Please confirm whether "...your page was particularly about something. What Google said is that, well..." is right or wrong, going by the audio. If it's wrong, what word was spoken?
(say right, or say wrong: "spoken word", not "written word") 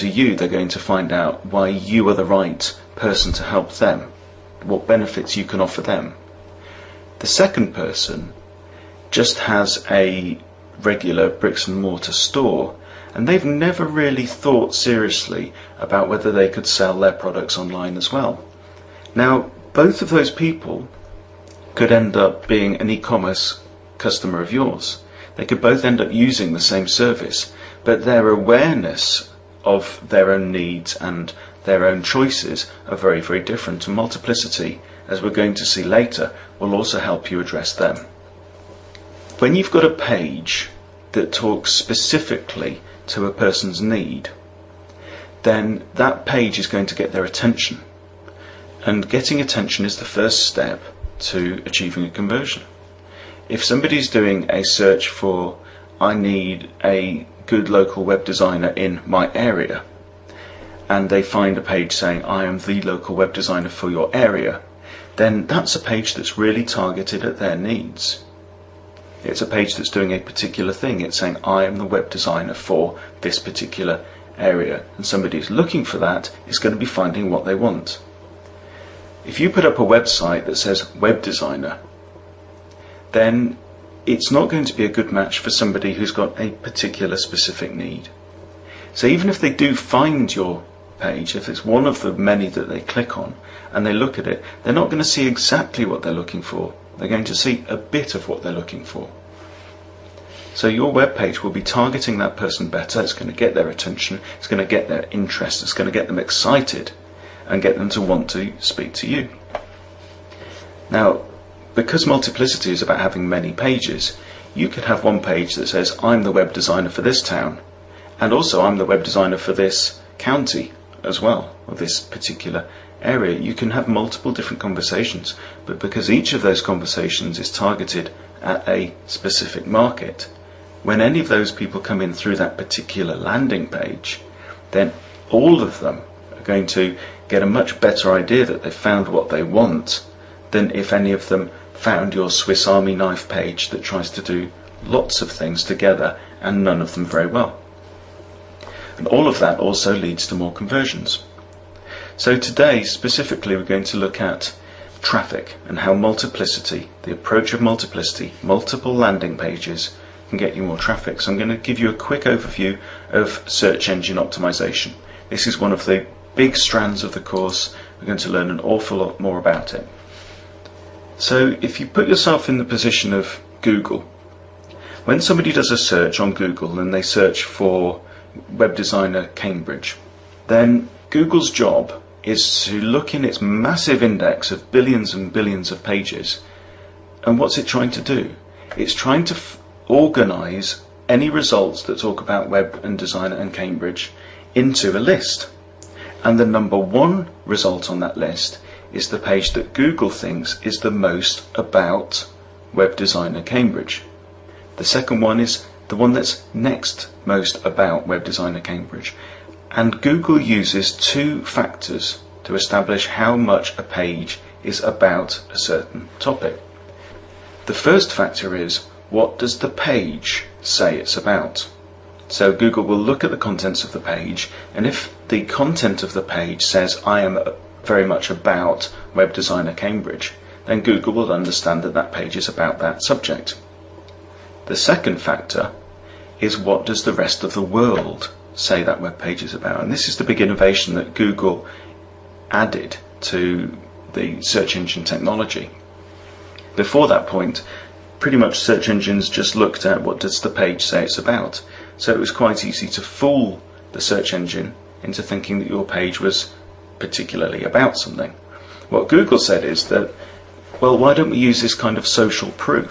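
right.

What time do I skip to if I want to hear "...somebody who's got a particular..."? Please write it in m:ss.
1:25.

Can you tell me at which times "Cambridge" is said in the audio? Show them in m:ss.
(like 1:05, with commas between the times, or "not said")
2:59, 3:13, 3:23, 3:28, 3:49.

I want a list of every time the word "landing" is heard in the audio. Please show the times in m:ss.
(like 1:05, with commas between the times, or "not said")
2:13, 2:38.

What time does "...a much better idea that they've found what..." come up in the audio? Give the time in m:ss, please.
2:17.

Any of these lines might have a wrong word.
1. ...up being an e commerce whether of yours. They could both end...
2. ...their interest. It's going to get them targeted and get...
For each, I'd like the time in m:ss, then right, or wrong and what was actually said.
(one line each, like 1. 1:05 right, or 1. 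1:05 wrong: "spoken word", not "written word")
1. 0:22 wrong: "customer", not "whether"
2. 1:44 wrong: "excited", not "targeted".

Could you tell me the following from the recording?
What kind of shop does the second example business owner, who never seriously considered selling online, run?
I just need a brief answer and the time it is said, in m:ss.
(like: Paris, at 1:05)
bricks and mortar store, at 0:11.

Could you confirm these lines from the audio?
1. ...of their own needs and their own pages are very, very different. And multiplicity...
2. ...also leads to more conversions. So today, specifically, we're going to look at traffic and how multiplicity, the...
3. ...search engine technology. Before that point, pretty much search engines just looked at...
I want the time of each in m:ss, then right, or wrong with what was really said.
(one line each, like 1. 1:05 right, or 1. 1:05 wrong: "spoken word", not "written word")
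1. 0:29 wrong: "choices", not "pages"
2. 2:29 right
3. 4:04 right.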